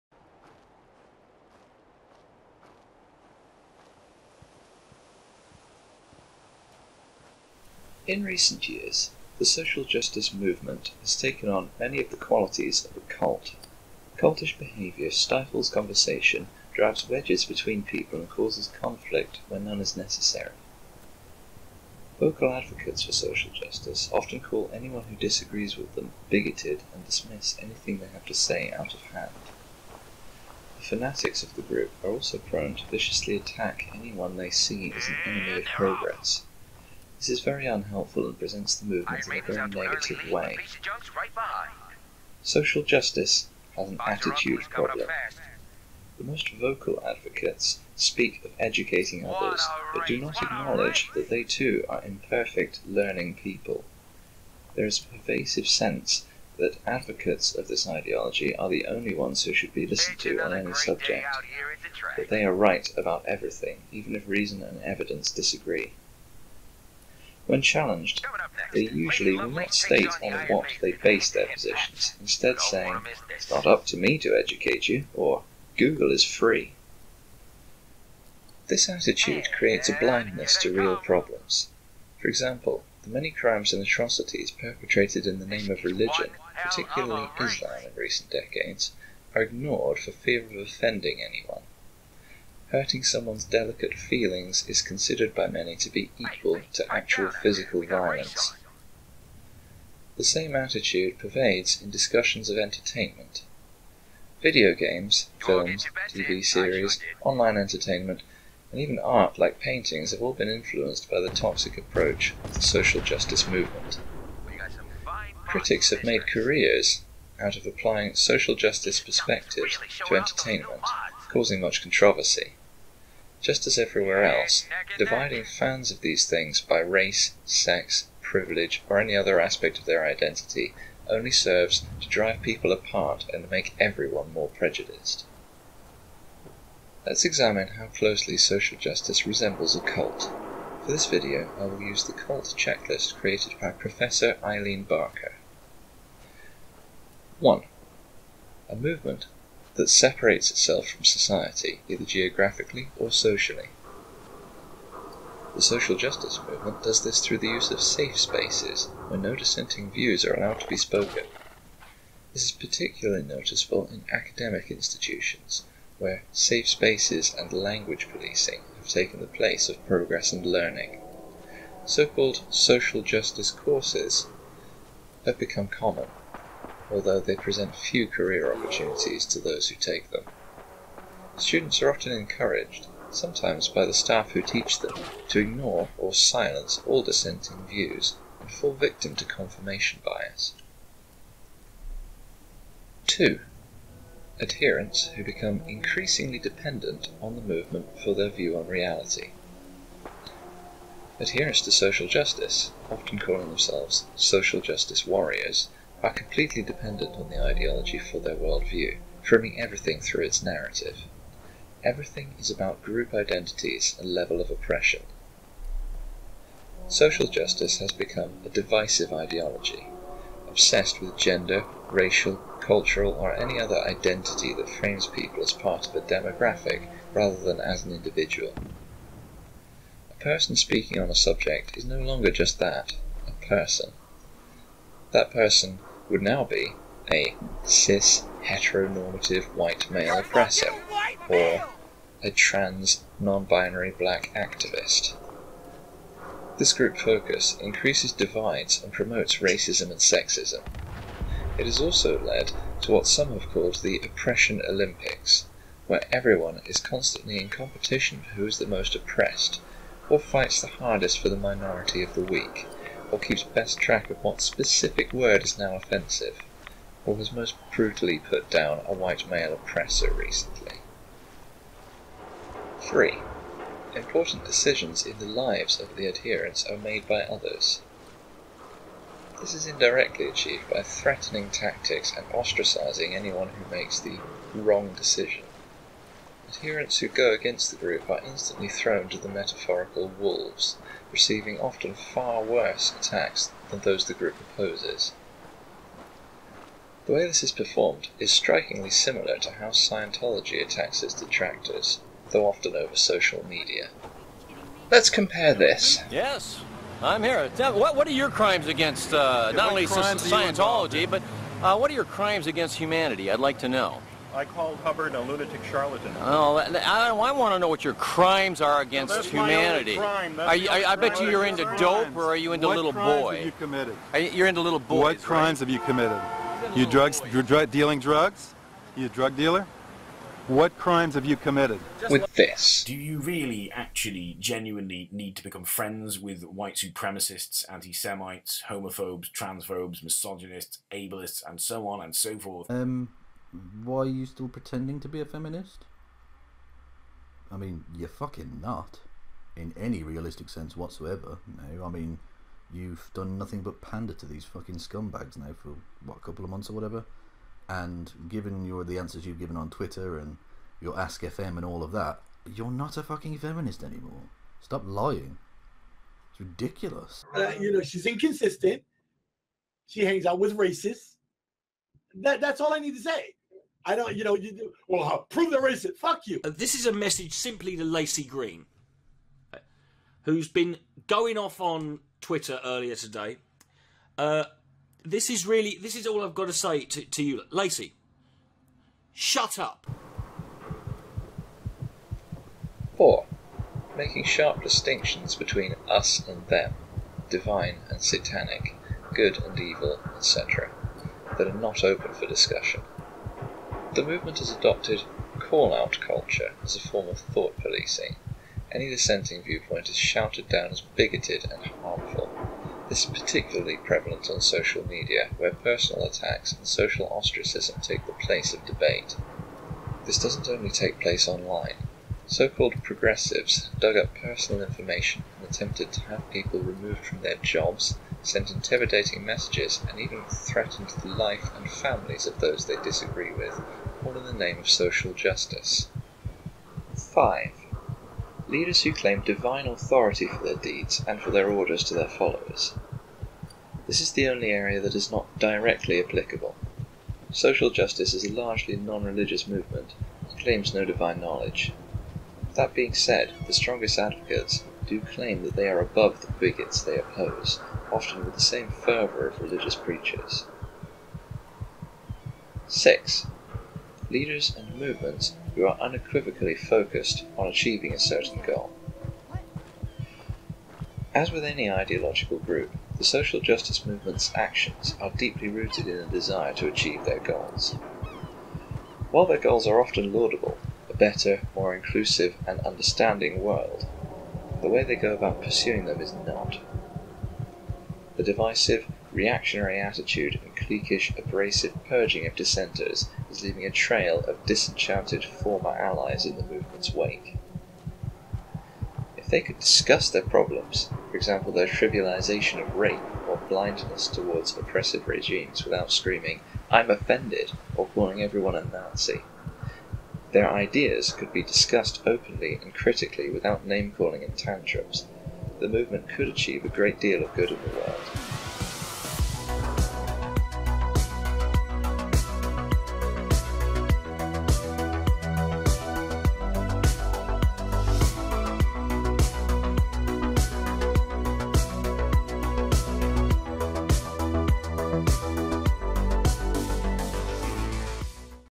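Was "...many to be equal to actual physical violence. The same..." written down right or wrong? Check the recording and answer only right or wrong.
right.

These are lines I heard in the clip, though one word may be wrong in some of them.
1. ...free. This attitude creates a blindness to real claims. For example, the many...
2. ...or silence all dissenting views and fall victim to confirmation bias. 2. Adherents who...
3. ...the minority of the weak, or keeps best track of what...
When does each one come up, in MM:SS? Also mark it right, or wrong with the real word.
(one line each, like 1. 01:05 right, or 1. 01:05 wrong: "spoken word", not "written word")
1. 01:16 wrong: "problems", not "claims"
2. 03:05 right
3. 04:21 right.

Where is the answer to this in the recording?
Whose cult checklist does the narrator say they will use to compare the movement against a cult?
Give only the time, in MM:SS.
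02:24.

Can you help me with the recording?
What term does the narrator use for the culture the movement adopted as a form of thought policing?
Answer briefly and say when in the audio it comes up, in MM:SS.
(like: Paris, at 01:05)
call out culture, at 06:45.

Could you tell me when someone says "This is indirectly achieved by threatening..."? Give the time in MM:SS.
04:39.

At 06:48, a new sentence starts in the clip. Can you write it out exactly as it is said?
Any dissenting viewpoint is shouted down as bigoted and harmful.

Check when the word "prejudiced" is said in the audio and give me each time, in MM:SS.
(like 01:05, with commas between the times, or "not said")
02:14.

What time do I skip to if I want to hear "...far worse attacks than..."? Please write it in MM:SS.
04:51.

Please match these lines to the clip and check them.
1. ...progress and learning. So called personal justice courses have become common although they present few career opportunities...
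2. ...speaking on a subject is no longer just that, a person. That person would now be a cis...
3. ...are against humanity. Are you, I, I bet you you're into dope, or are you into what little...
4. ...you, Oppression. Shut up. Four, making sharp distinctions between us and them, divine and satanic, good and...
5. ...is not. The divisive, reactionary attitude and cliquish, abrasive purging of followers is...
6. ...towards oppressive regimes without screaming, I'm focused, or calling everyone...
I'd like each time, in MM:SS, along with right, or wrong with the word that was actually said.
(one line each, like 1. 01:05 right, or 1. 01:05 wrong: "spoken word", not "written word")
1. 02:49 wrong: "social", not "personal"
2. 03:50 right
3. 05:18 right
4. 06:27 wrong: "Laci", not "Oppression"
5. 08:06 wrong: "dissenters", not "followers"
6. 08:24 wrong: "offended", not "focused".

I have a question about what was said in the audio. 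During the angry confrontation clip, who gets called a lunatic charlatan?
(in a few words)
Hubbard.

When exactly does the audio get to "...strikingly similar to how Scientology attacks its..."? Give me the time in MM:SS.
04:58.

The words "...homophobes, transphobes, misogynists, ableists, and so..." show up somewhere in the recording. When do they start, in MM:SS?
05:38.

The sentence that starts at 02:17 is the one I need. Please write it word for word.
Let's examine how closely social justice resembles a cult.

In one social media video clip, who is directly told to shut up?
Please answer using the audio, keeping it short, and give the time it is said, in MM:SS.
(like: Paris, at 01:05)
Laci Green, at 06:17.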